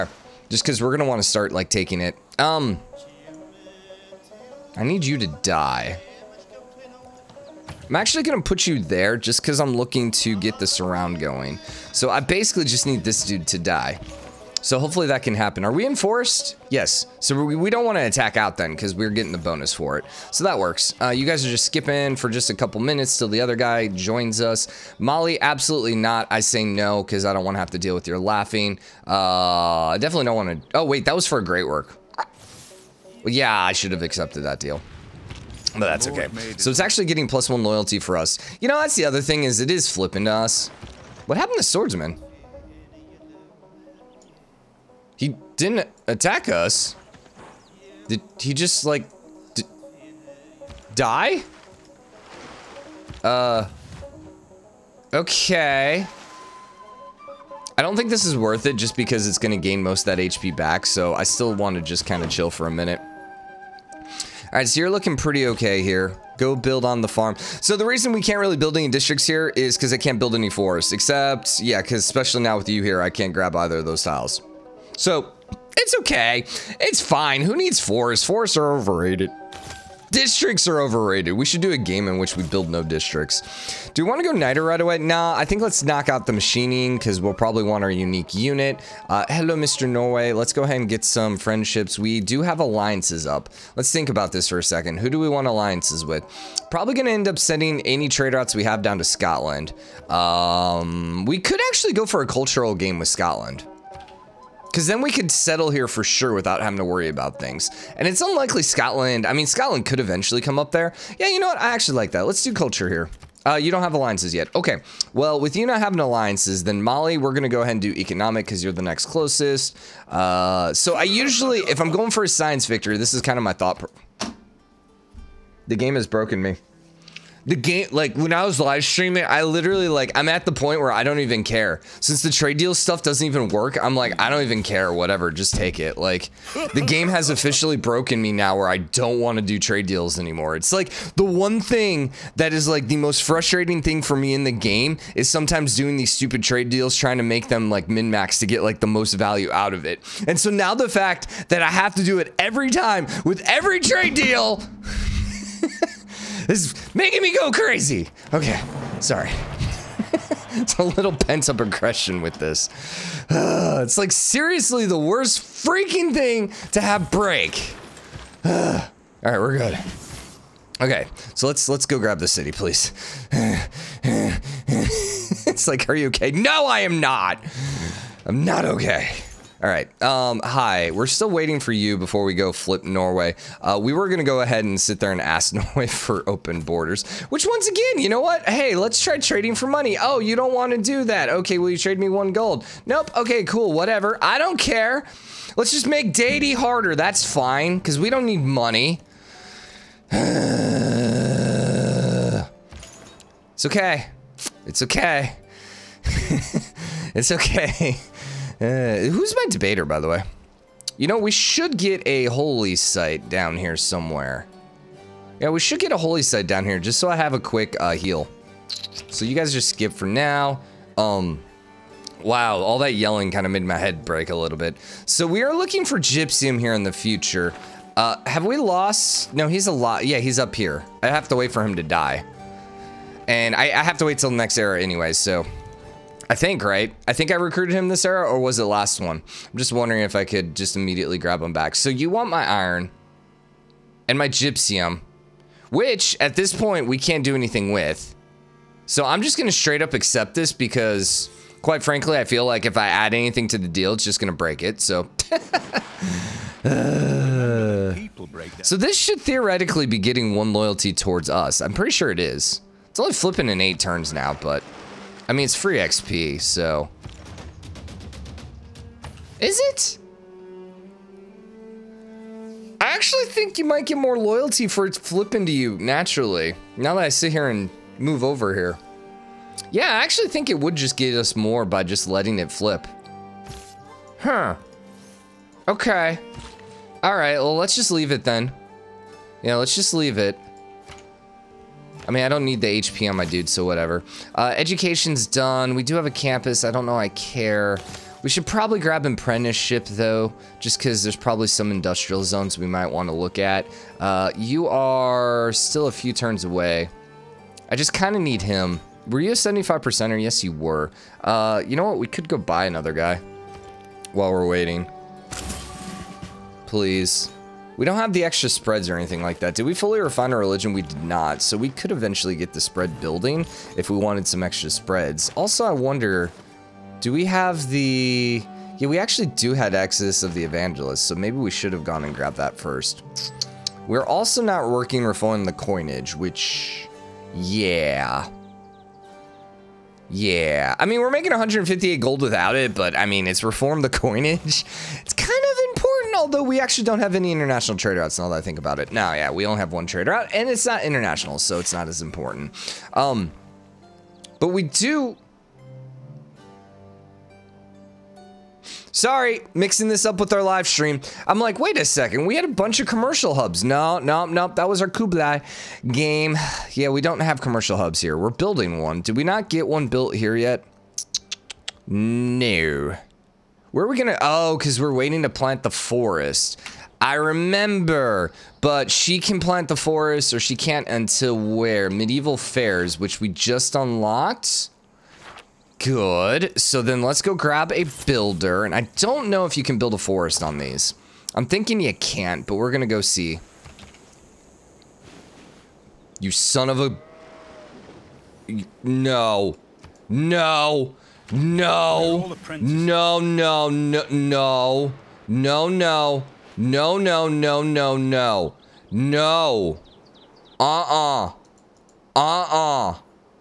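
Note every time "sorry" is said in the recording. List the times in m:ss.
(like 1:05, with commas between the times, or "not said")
2:39, 5:58.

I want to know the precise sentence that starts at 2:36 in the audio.
This is making me go crazy.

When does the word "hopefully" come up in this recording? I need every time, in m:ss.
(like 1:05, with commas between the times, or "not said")
0:14.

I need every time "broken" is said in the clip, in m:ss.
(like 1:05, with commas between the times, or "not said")
2:06, 2:17.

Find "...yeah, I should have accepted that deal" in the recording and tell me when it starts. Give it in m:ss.
0:33.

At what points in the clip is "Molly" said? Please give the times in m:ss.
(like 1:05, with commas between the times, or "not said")
0:24, 1:56.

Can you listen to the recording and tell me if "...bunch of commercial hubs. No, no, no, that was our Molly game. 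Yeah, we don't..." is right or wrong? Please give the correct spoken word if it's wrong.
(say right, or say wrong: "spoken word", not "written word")
wrong: "Kublai", not "Molly".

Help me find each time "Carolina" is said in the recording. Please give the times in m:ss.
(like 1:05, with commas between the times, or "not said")
not said.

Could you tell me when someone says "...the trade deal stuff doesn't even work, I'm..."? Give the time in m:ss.
2:12.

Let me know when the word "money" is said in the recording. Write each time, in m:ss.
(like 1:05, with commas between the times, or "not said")
3:09, 3:18.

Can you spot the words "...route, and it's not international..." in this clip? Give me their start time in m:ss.
5:50.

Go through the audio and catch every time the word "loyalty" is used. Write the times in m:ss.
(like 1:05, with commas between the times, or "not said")
0:37, 4:20, 4:34.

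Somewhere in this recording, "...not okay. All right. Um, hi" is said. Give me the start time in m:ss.
2:58.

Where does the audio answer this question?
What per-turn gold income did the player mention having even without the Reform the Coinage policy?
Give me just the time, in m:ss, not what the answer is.
5:41.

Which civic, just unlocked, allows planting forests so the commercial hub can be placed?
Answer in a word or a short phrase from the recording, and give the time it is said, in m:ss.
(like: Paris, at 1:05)
Medieval Faires, at 6:21.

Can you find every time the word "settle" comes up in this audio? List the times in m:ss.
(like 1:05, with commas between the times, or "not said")
1:45.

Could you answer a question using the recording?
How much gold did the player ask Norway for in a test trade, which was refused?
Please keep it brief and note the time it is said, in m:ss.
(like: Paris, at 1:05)
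1 gold, at 3:12.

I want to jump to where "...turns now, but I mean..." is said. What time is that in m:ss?
4:23.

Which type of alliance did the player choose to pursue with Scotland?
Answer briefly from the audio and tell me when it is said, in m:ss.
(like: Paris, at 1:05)
Culture, at 1:52.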